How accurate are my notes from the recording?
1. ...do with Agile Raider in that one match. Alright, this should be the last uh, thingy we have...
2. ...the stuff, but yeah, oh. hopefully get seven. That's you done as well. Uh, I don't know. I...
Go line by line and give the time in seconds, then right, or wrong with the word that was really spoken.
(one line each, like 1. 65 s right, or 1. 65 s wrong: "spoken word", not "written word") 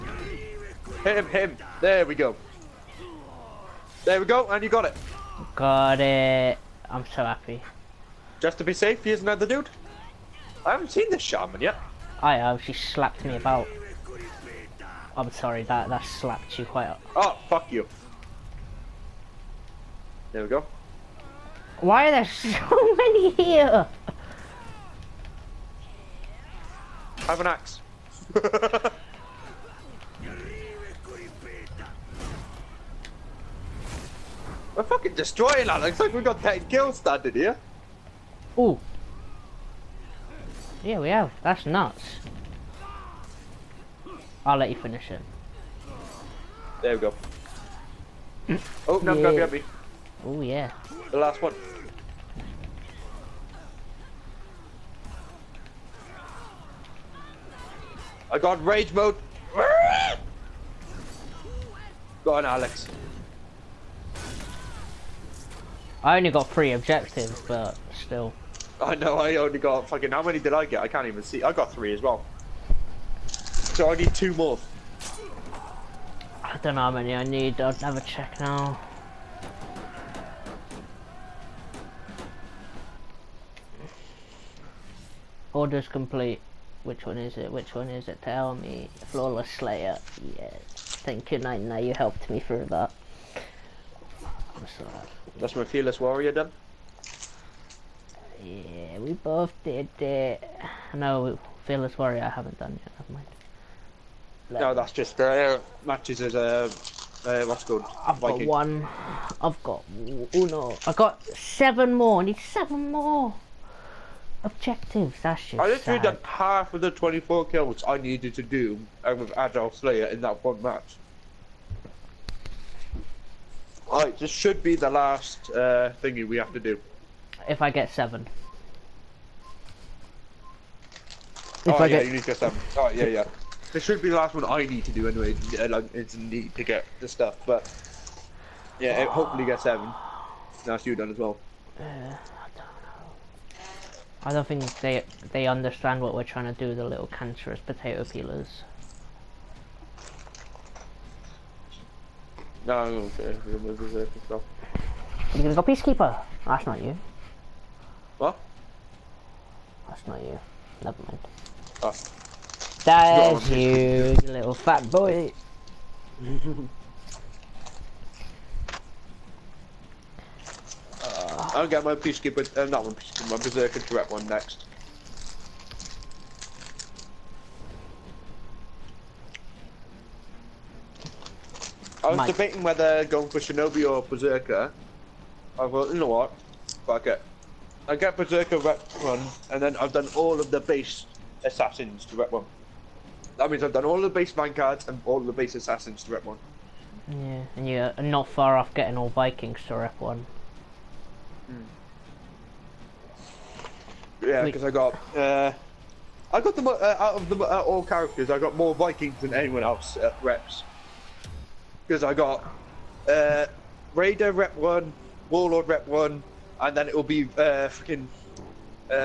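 1. 118 s wrong: "Slayer", not "Raider"
2. 136 s right.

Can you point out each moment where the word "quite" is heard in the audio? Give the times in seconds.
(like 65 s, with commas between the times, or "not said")
16 s.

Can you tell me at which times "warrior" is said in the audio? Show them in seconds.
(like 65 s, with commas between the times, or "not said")
95 s, 101 s.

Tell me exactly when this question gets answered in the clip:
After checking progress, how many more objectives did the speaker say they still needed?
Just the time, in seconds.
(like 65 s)
112 s.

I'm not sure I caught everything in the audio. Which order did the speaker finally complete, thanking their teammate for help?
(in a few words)
Flawless Slayer.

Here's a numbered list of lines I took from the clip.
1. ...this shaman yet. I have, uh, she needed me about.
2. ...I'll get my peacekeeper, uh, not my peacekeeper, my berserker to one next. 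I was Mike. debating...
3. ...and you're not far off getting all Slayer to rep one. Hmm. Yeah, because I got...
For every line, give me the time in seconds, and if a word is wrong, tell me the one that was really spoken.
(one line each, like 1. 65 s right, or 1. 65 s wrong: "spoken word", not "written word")
1. 11 s wrong: "slapped", not "needed"
2. 171 s right
3. 197 s wrong: "Vikings", not "Slayer".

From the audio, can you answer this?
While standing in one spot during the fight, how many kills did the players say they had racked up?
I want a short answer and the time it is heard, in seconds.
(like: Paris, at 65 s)
10, at 36 s.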